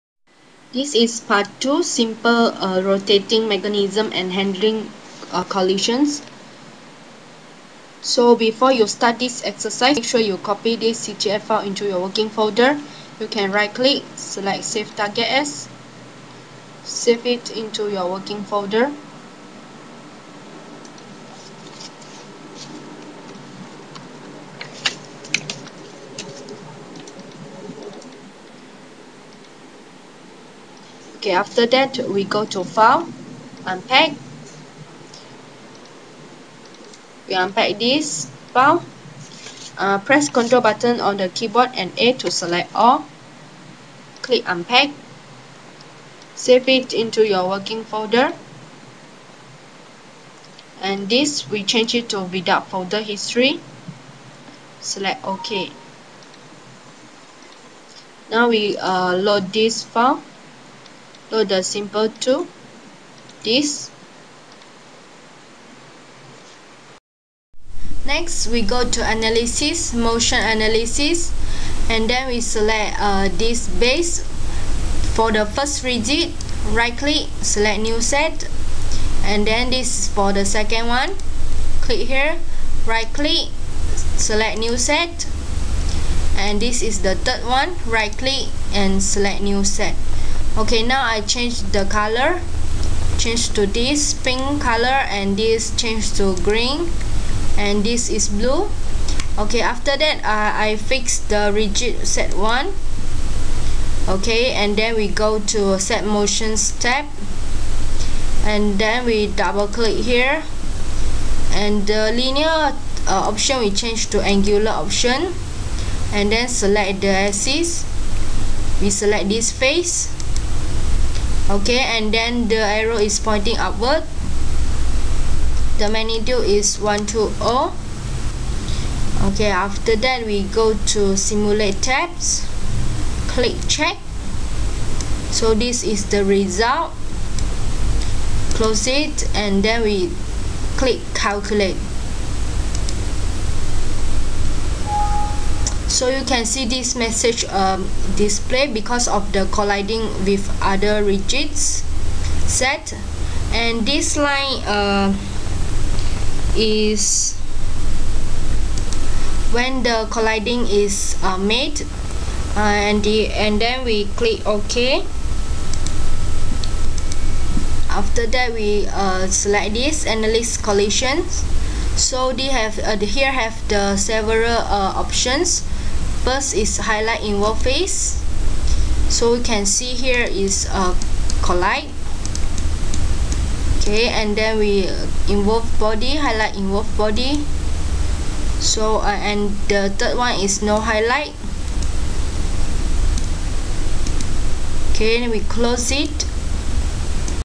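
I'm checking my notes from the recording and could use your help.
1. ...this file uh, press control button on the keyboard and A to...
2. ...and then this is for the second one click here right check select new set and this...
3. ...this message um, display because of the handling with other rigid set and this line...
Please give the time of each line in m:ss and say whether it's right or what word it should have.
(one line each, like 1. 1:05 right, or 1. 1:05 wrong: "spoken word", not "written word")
1. 0:37 right
2. 1:19 wrong: "click", not "check"
3. 2:26 wrong: "colliding", not "handling".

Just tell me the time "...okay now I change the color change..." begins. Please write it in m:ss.
1:30.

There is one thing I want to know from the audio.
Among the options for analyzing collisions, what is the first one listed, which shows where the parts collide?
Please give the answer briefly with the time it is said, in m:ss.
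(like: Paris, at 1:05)
Highlight in face, at 2:56.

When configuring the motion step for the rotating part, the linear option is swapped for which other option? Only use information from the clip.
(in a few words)
Angular.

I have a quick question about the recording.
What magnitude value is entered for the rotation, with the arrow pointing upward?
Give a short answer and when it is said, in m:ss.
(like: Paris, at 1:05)
120, at 2:06.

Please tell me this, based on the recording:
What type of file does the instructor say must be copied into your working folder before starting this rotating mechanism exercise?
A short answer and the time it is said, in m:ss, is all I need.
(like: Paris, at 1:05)
CTF file, at 0:11.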